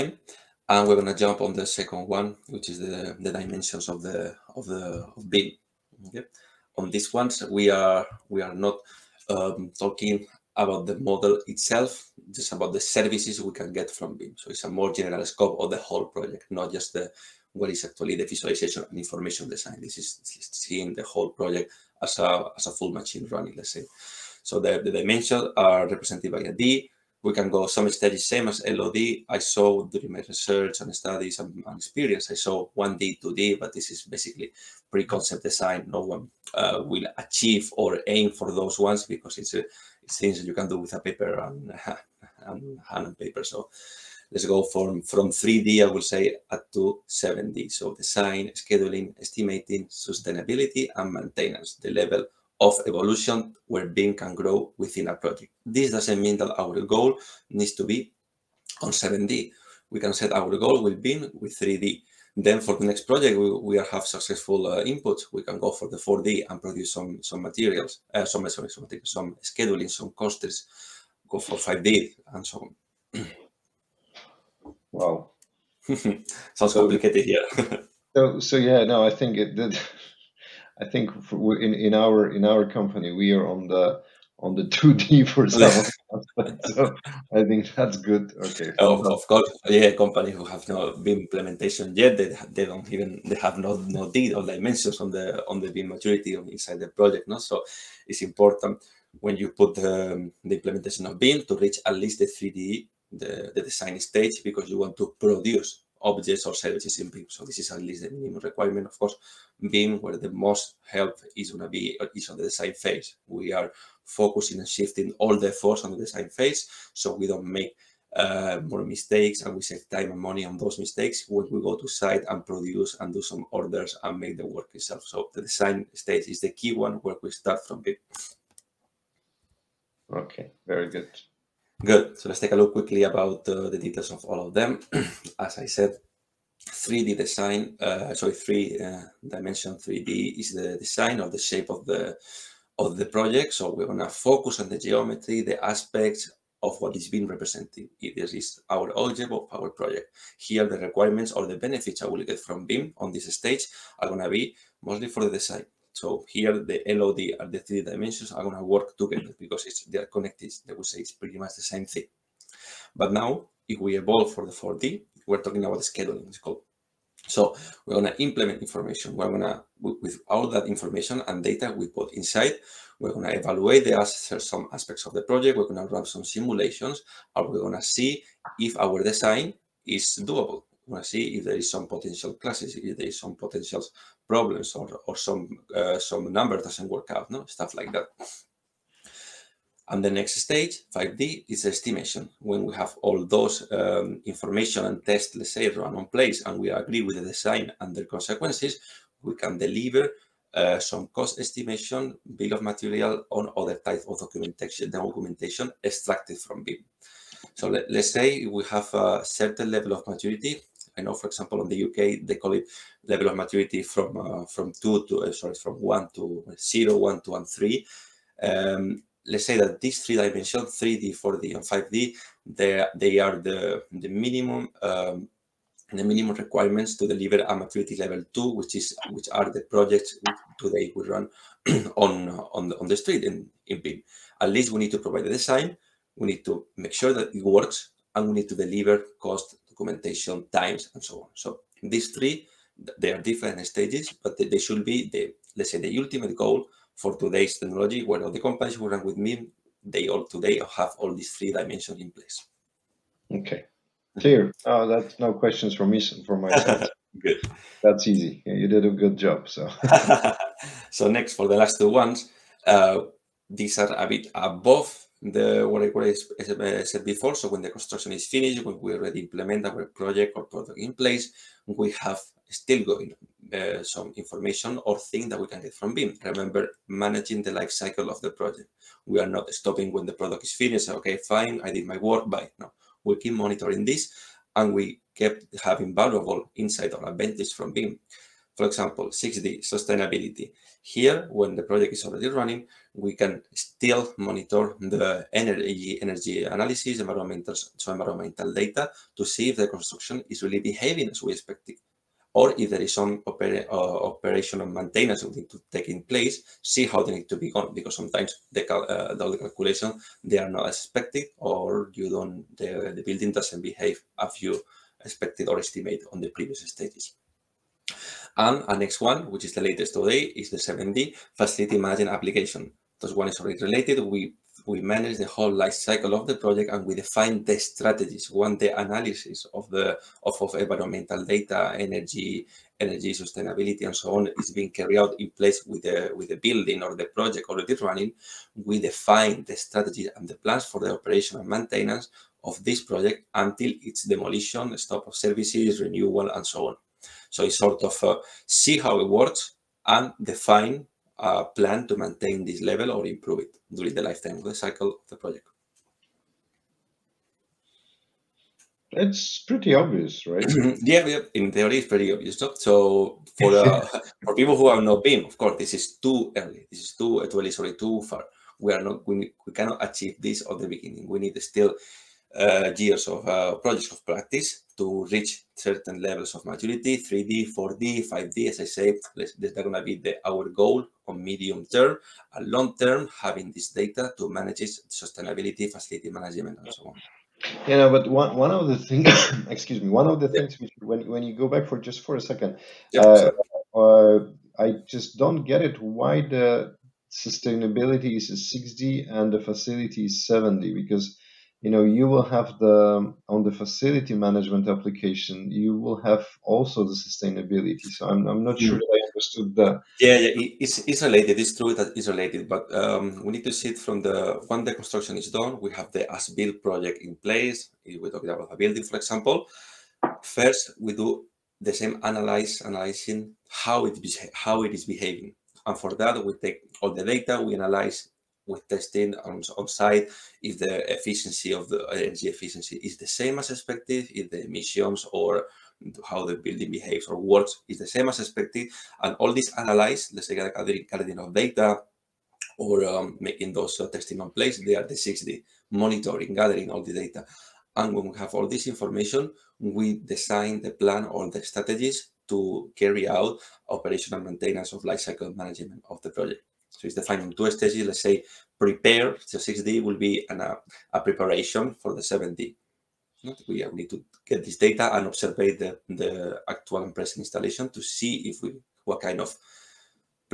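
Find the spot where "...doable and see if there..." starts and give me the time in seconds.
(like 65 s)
180 s.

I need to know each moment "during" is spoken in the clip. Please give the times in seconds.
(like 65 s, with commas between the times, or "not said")
29 s, 353 s.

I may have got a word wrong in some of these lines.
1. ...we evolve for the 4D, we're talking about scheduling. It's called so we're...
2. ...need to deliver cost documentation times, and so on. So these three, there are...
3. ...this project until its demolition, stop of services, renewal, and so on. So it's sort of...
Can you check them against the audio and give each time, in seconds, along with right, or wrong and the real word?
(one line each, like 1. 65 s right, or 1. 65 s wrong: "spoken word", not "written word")
1. 163 s right
2. 238 s right
3. 342 s right.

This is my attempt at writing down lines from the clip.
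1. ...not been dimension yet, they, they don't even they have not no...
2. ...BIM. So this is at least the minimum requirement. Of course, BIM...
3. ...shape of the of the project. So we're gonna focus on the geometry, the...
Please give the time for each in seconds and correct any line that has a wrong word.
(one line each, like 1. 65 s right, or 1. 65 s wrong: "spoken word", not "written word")
1. 90 s wrong: "implementation", not "dimension"
2. 107 s right
3. 141 s right.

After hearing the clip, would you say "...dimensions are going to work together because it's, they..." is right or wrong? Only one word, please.
right.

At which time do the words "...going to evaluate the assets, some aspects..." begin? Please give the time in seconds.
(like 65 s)
173 s.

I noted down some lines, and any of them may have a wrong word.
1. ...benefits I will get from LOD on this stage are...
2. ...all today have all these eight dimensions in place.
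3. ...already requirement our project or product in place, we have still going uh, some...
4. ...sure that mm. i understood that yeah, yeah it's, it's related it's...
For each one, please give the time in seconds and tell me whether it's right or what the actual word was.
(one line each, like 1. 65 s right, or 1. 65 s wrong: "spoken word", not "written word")
1. 151 s wrong: "BIM", not "LOD"
2. 250 s wrong: "three", not "eight"
3. 268 s wrong: "implement", not "requirement"
4. 408 s right.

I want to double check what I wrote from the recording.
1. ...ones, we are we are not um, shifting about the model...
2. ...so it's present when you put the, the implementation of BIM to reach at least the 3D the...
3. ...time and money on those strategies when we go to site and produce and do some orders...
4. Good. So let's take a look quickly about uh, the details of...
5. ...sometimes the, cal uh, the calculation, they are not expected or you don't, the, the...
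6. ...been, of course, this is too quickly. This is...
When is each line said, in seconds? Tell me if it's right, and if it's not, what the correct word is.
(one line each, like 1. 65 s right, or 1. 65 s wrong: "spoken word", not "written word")
1. 7 s wrong: "talking", not "shifting"
2. 97 s wrong: "important", not "present"
3. 119 s wrong: "mistakes", not "strategies"
4. 131 s right
5. 307 s right
6. 365 s wrong: "early", not "quickly".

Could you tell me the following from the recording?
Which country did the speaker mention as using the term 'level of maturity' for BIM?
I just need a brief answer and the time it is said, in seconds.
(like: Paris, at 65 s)
UK, at 211 s.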